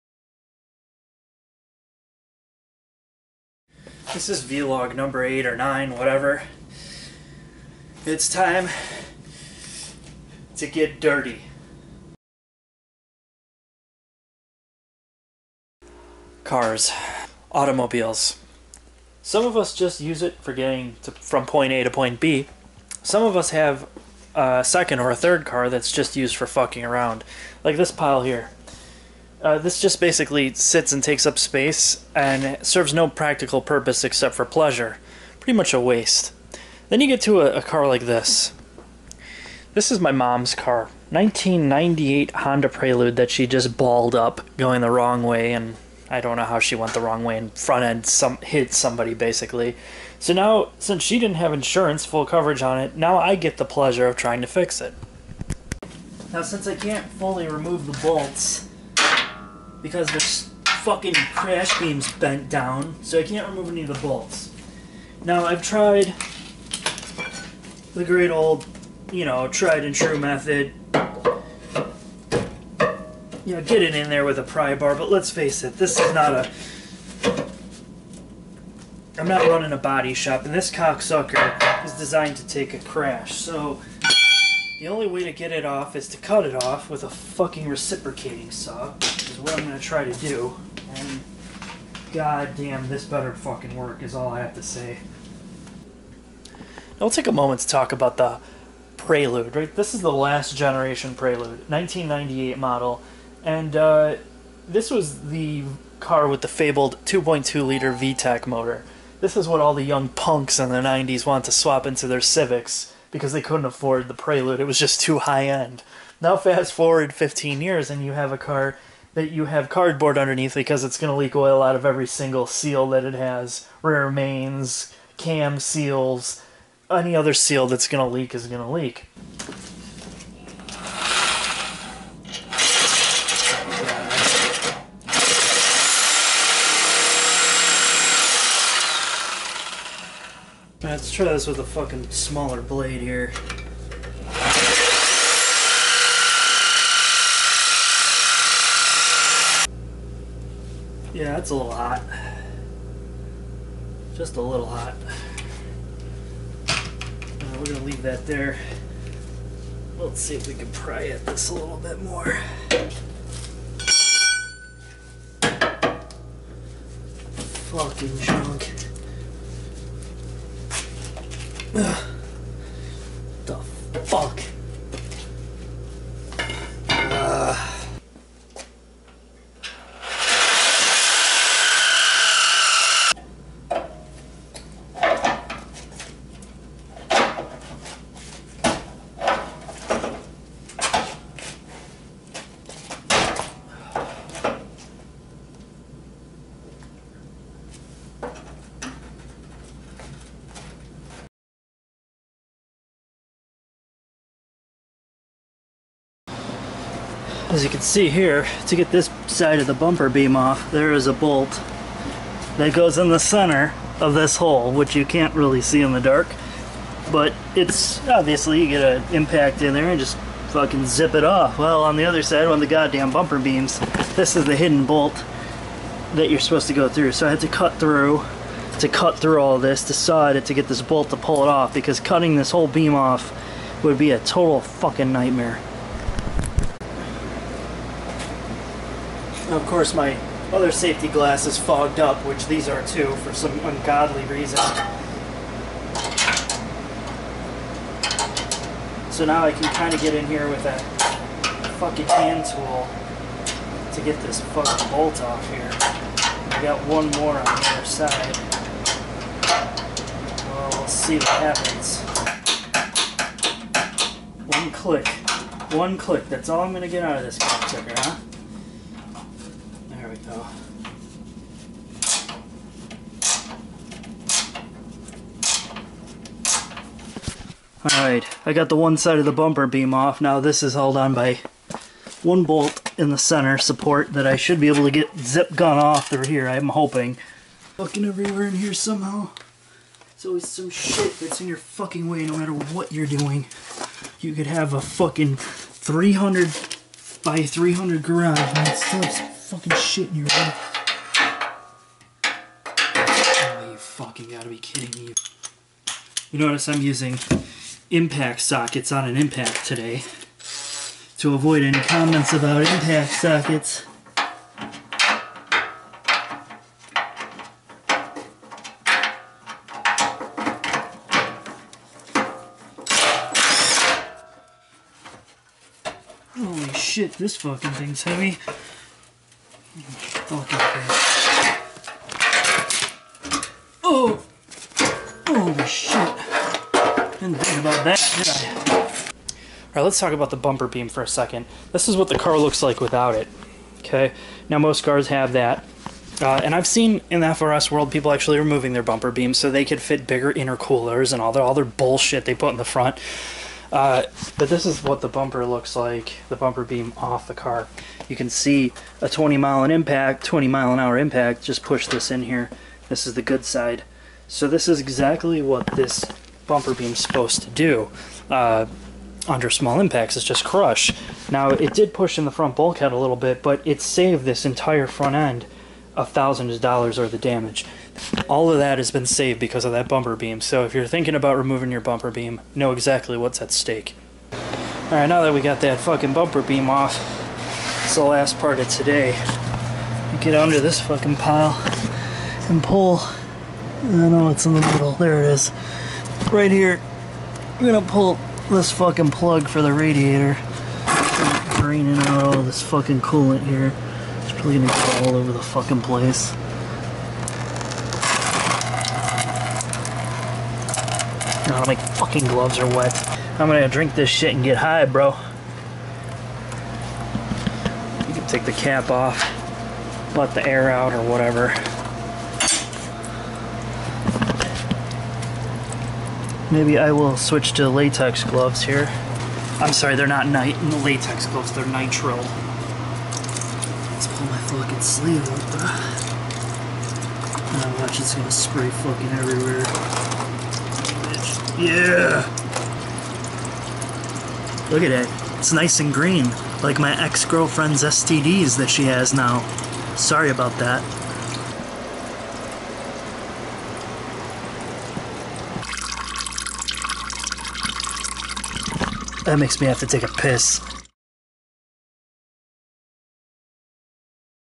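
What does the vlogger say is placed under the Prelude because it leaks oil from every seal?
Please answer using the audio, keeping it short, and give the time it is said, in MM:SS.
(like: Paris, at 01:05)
Cardboard, at 01:59.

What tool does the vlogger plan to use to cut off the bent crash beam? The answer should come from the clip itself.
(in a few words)
Reciprocating saw.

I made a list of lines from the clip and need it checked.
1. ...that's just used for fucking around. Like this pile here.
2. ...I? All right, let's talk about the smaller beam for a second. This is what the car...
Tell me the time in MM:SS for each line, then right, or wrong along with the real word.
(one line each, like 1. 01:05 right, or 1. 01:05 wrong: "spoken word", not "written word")
1. 00:25 right
2. 05:38 wrong: "bumper", not "smaller".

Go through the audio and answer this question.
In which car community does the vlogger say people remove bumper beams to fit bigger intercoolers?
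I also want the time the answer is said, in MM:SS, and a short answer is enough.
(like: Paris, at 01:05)
FRS, at 05:47.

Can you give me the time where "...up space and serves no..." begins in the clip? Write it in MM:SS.
00:31.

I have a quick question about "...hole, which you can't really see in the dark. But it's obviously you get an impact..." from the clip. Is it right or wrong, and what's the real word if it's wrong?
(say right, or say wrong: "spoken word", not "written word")
right.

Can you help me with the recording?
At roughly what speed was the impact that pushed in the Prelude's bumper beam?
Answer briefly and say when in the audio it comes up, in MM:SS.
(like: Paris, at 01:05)
20 mph, at 06:00.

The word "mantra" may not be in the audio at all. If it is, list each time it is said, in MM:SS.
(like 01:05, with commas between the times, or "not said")
not said.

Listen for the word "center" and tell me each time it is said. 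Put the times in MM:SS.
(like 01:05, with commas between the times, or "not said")
03:33, 04:43.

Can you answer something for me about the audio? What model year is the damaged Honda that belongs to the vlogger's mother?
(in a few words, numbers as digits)
1998.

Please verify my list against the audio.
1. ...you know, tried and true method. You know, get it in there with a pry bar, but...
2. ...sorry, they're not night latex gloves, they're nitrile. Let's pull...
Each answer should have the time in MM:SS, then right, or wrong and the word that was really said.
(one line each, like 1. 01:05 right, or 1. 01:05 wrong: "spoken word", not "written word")
1. 01:09 right
2. 07:09 right.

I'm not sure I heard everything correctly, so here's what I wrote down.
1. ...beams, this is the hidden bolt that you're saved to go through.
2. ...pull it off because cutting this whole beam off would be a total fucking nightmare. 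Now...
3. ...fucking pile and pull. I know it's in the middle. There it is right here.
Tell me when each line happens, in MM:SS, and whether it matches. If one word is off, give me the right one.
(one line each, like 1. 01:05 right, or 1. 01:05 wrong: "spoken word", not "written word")
1. 03:43 wrong: "supposed", not "saved"
2. 03:51 right
3. 06:30 right.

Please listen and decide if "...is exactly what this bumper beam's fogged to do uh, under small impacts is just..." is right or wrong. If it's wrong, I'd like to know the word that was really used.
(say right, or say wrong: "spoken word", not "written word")
wrong: "supposed", not "fogged".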